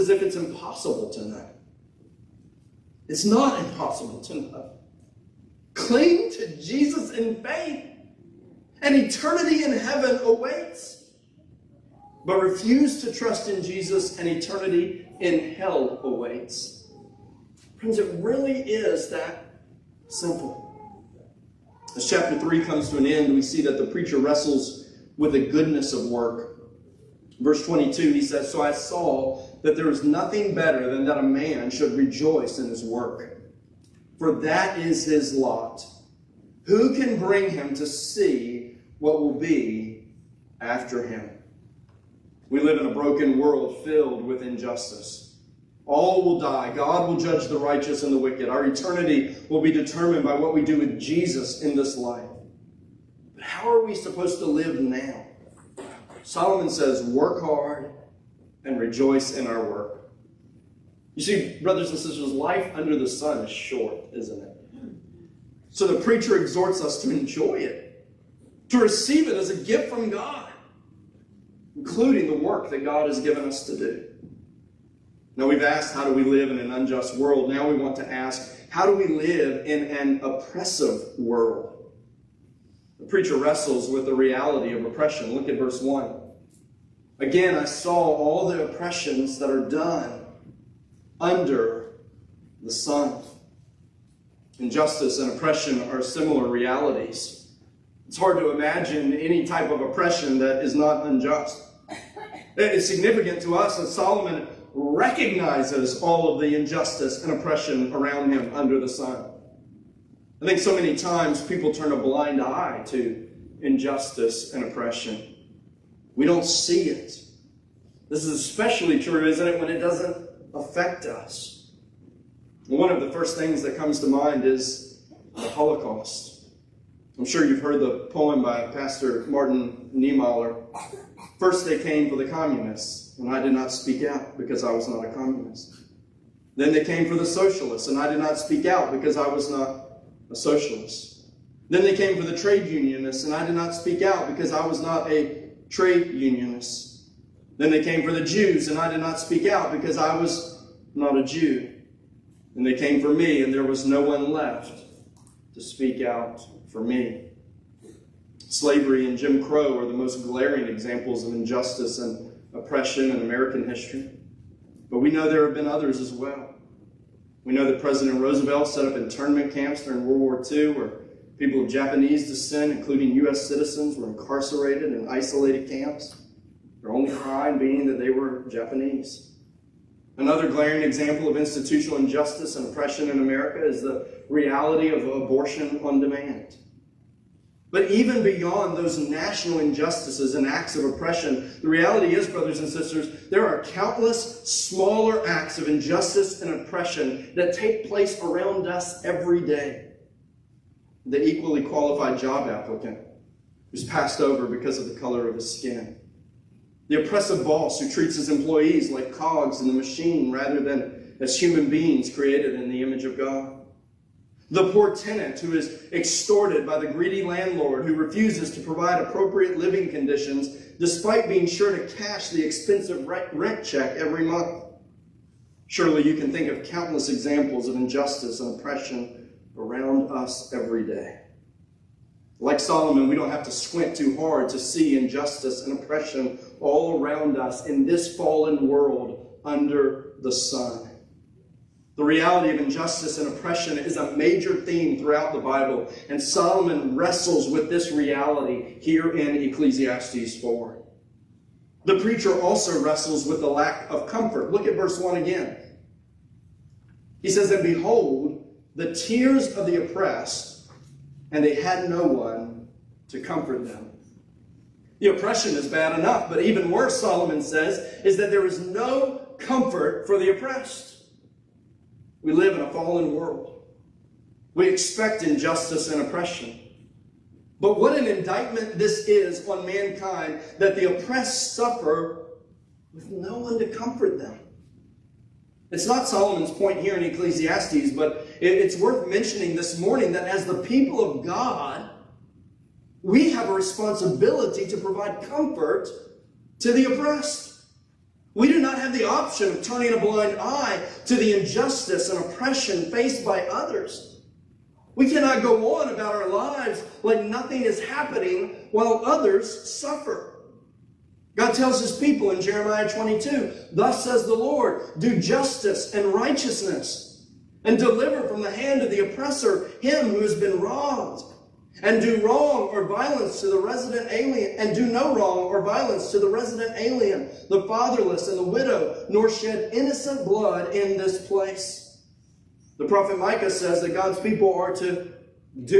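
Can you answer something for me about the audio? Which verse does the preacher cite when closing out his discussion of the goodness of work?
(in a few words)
Verse 22.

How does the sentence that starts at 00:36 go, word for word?
Who can bring him to see what will be after him?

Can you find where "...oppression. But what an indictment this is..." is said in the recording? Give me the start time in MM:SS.
04:36.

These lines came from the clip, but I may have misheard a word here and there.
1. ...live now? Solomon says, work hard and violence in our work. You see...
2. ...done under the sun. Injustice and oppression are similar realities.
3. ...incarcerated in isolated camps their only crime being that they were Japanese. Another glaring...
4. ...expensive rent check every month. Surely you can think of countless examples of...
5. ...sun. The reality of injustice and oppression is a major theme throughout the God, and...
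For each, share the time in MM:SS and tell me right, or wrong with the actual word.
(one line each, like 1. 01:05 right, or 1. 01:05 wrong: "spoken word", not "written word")
1. 00:54 wrong: "rejoice", not "violence"
2. 01:29 right
3. 02:54 right
4. 03:42 right
5. 04:00 wrong: "Bible", not "God".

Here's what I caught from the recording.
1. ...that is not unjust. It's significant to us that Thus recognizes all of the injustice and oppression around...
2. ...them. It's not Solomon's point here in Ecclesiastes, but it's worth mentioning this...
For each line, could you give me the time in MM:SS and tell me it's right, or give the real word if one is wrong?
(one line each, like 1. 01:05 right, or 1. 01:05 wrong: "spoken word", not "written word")
1. 01:40 wrong: "Solomon", not "Thus"
2. 04:44 right.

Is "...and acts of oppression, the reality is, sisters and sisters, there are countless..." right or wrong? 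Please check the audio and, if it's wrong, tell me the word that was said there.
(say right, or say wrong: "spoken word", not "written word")
wrong: "brothers", not "sisters".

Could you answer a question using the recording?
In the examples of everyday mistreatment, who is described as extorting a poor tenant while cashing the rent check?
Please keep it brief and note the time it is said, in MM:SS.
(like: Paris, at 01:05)
The greedy landlord, at 03:36.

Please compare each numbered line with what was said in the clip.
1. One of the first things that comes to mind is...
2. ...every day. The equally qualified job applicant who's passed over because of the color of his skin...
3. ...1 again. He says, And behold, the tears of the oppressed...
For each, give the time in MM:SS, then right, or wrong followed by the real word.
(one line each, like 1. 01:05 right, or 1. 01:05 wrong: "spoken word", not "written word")
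1. 02:02 right
2. 03:19 right
3. 04:14 right.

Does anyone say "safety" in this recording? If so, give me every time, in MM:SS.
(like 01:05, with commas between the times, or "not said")
not said.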